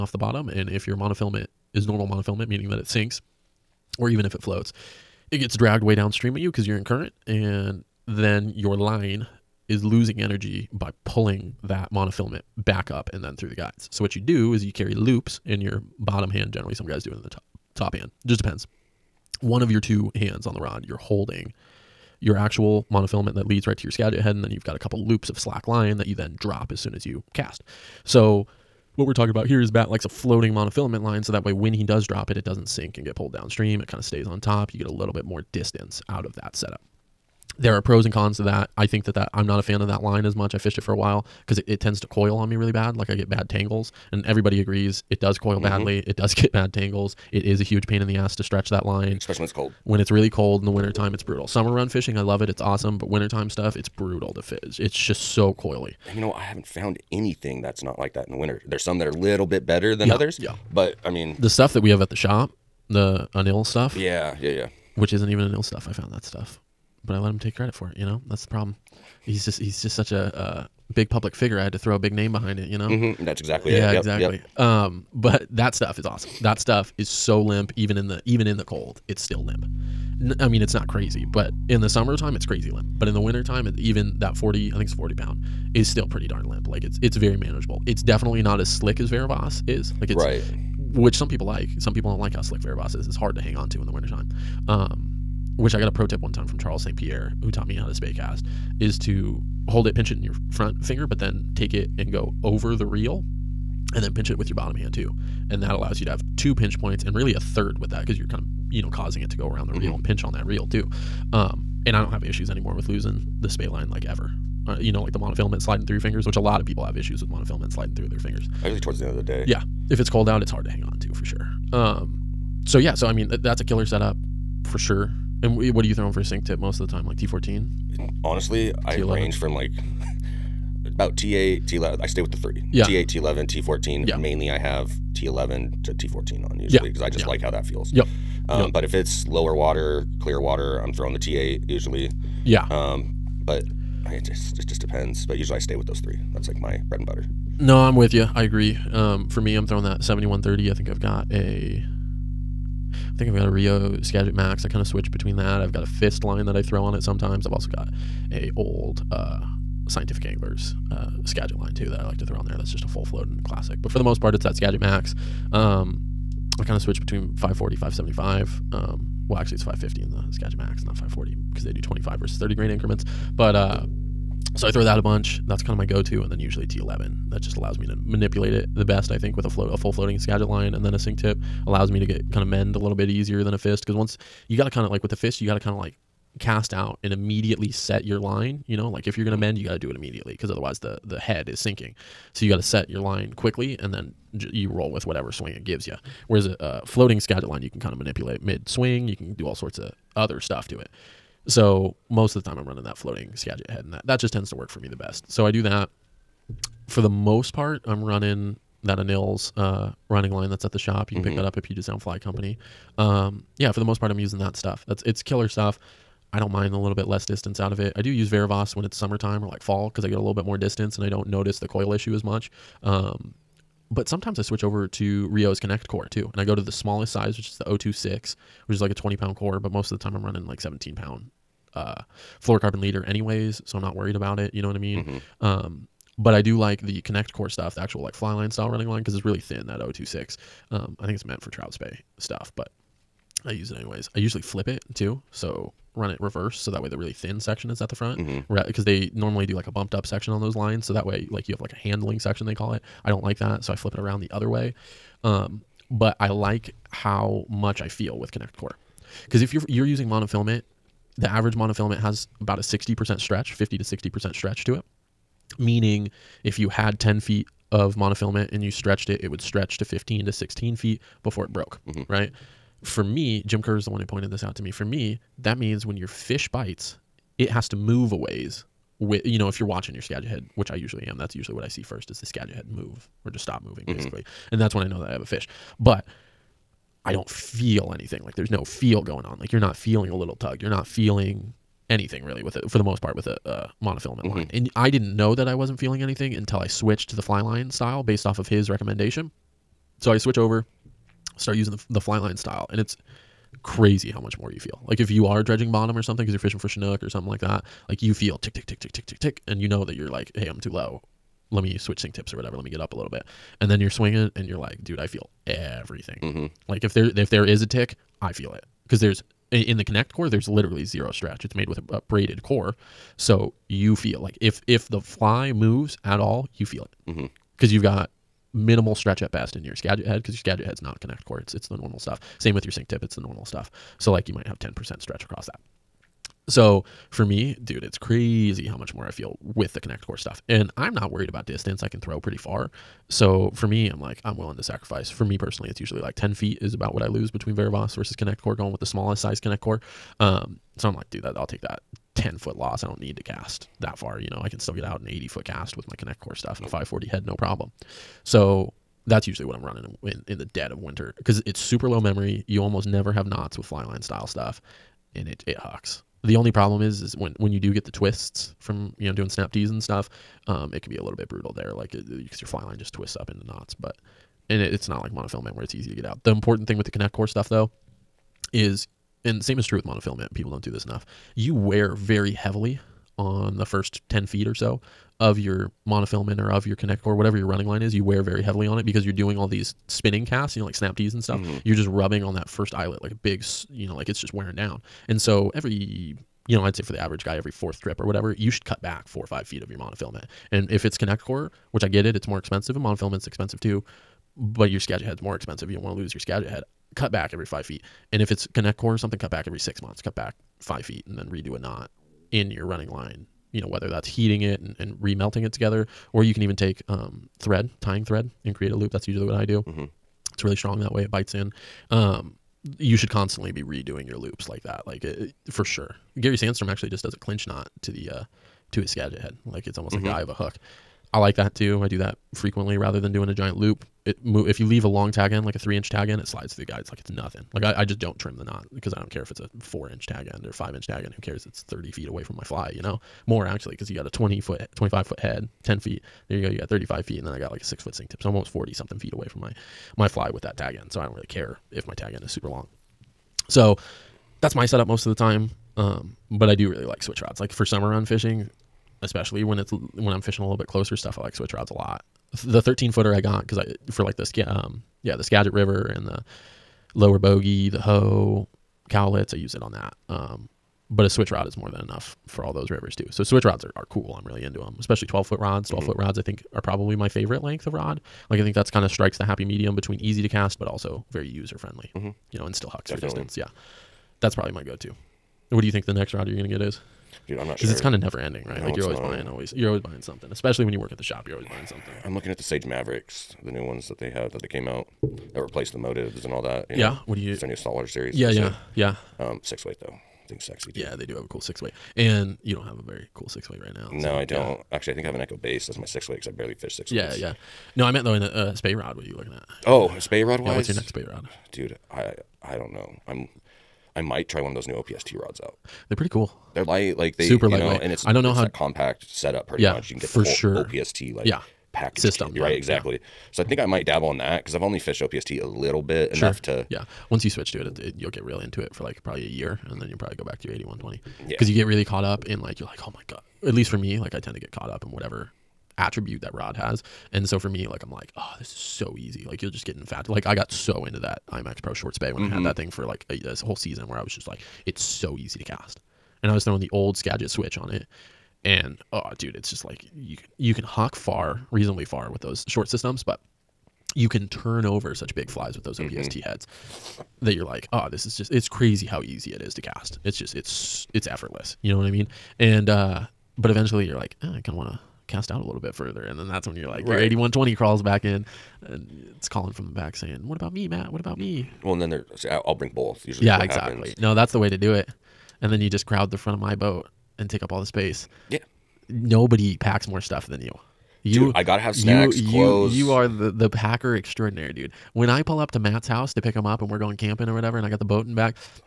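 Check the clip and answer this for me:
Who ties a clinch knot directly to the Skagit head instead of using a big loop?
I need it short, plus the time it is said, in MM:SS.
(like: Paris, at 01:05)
Gary Sandstrom, at 07:06.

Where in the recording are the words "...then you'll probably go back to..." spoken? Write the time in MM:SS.
08:49.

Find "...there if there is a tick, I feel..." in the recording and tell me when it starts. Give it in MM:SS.
05:16.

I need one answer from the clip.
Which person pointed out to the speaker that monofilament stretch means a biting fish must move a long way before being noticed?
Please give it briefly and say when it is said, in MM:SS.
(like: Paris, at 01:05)
Jim Kerr, at 04:33.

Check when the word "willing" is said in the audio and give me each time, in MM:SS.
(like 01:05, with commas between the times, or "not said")
05:44.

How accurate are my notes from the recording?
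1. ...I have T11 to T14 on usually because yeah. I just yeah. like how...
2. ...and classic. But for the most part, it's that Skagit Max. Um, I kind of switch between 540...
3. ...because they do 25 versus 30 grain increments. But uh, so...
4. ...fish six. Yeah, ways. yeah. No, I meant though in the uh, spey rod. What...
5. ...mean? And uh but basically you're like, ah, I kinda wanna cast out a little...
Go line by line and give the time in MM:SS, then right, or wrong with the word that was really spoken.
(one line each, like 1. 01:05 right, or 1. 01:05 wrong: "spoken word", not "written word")
1. 02:14 right
2. 02:43 right
3. 02:51 right
4. 08:26 right
5. 09:21 wrong: "eventually", not "basically".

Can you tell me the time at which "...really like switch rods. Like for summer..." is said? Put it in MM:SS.
07:36.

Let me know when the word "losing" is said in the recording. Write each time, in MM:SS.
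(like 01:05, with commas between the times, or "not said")
00:09, 01:52.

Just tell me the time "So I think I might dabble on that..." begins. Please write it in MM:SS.
08:43.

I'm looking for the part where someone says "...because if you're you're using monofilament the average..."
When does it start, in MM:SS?
04:19.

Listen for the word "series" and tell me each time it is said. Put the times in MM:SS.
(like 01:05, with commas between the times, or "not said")
08:17.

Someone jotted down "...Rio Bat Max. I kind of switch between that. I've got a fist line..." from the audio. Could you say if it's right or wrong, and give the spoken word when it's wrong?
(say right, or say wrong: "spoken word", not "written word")
wrong: "Skagit", not "Bat".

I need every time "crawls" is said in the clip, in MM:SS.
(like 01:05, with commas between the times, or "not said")
09:27.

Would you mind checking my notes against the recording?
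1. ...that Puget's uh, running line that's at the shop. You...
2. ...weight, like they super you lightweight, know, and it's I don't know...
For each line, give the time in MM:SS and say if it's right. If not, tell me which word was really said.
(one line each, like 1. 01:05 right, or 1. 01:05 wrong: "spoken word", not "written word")
1. 03:28 wrong: "Anil", not "Puget"
2. 08:36 wrong: "light", not "weight".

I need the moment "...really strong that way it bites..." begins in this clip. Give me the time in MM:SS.
07:00.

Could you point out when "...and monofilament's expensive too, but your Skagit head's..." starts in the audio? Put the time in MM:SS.
06:42.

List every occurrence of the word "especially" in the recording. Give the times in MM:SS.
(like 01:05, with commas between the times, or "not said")
00:49, 07:39, 07:54, 08:10.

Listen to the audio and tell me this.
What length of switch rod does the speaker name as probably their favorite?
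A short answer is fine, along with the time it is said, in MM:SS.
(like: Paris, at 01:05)
12 foot, at 07:55.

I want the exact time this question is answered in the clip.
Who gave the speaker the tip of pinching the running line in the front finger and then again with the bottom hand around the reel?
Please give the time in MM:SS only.
01:36.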